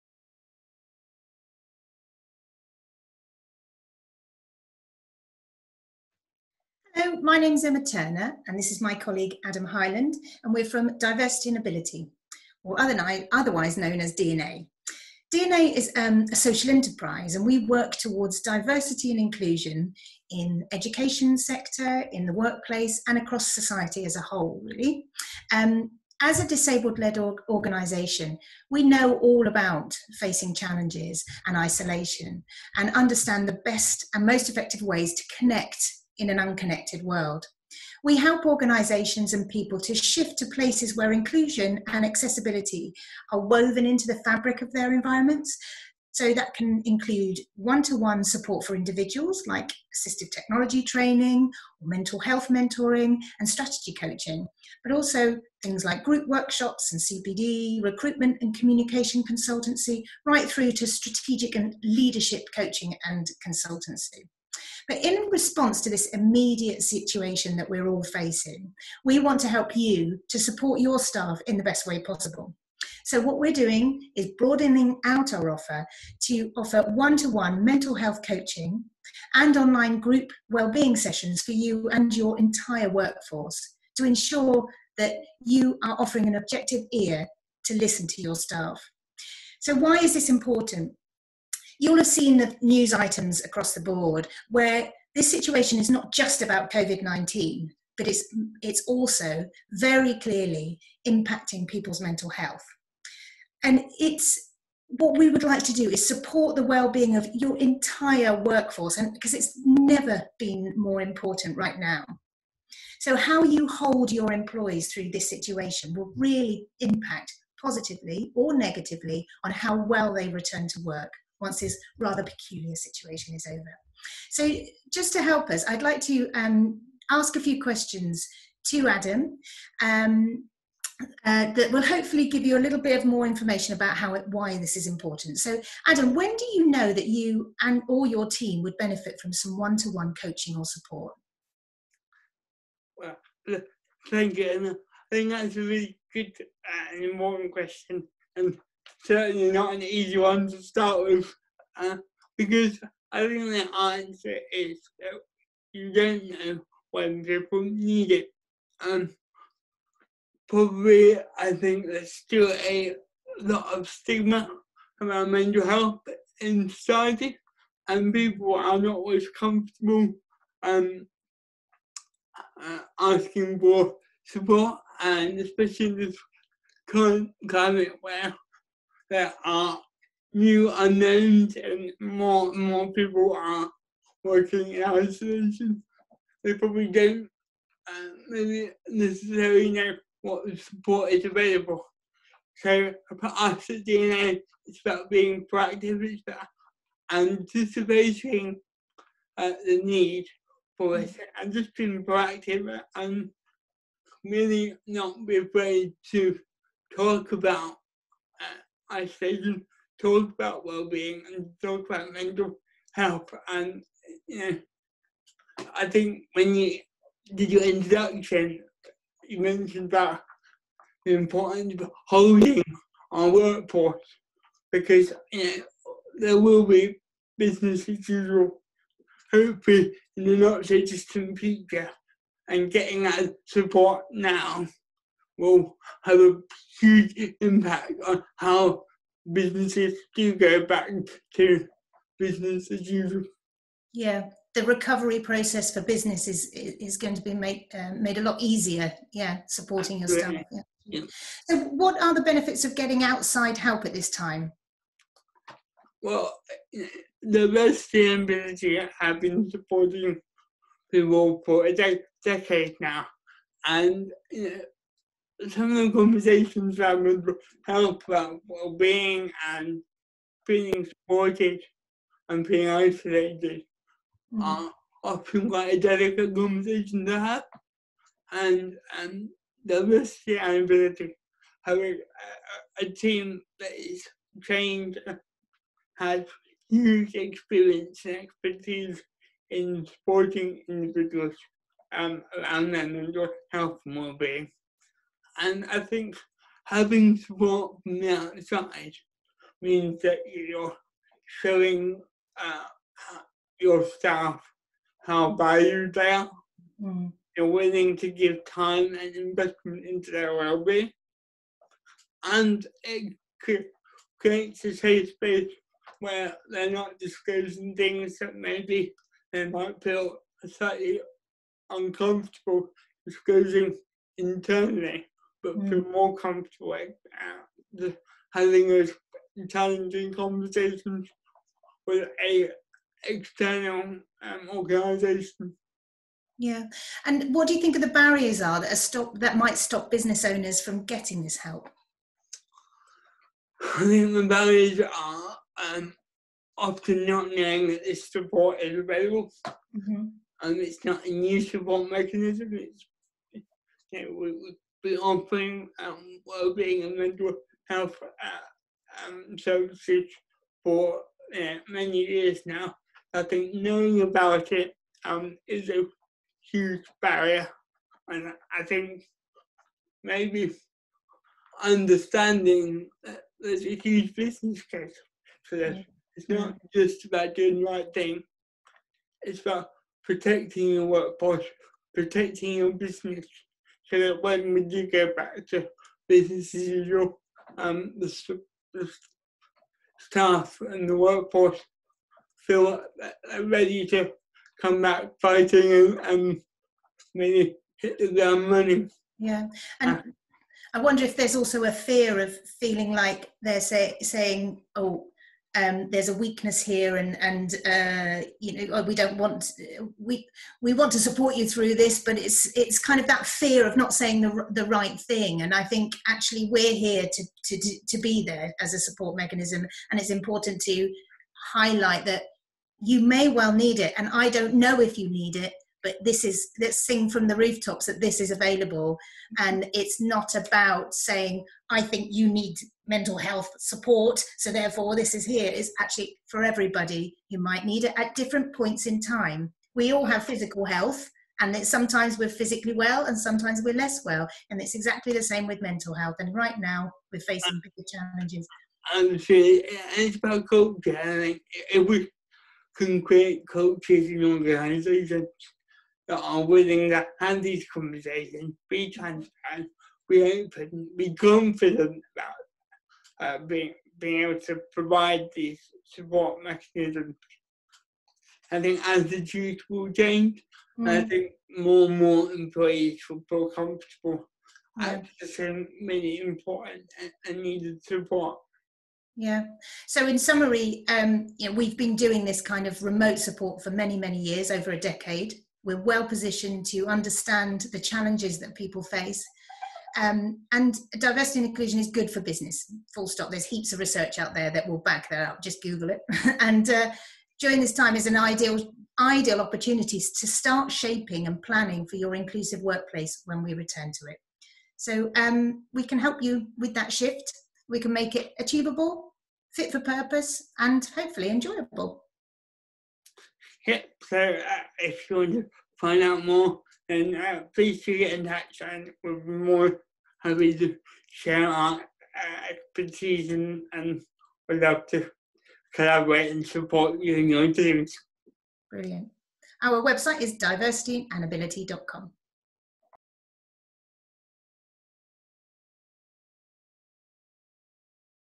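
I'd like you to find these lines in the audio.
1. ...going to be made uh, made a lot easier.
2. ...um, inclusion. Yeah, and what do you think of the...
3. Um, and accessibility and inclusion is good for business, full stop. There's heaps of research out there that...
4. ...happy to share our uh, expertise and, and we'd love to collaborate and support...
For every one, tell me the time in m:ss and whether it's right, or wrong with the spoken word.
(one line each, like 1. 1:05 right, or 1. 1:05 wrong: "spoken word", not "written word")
1. 4:06 right
2. 5:34 wrong: "organization", not "inclusion"
3. 8:09 wrong: "diversity", not "accessibility"
4. 8:40 right.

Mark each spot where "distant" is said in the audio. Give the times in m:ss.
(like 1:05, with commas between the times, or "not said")
3:50.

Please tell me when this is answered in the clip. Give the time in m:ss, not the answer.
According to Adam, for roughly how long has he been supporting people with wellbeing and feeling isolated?
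4:21.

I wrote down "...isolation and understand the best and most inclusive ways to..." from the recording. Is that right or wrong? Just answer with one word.
wrong.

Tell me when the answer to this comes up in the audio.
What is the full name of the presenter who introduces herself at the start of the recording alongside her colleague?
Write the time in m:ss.
0:07.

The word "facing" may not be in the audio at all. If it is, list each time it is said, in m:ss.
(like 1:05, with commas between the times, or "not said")
0:30, 1:08, 7:27.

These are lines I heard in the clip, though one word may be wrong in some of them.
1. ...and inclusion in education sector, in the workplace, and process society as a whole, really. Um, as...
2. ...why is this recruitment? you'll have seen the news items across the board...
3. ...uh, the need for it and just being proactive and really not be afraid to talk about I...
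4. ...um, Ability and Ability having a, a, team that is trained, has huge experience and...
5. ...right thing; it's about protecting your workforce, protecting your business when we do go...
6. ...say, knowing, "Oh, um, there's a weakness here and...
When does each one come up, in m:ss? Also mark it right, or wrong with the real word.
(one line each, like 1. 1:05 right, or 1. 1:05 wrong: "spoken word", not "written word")
1. 0:19 wrong: "across", not "process"
2. 1:29 wrong: "important", not "recruitment"
3. 3:19 right
4. 4:39 wrong: "Diversity", not "Ability"
5. 6:17 right
6. 6:43 wrong: "saying", not "knowing".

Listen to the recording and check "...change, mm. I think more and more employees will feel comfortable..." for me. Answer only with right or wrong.
right.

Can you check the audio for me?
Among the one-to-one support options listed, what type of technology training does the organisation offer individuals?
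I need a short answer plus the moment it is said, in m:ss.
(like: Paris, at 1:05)
assistive technology, at 0:49.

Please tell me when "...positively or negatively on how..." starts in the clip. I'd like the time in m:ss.
1:57.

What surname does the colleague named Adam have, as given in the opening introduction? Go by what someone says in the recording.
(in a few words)
Highland.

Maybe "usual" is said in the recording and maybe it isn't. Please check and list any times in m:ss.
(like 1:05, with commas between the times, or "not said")
3:48, 4:02, 6:26.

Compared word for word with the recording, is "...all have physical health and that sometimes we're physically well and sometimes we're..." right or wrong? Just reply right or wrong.
right.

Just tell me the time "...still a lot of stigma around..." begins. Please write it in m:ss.
2:42.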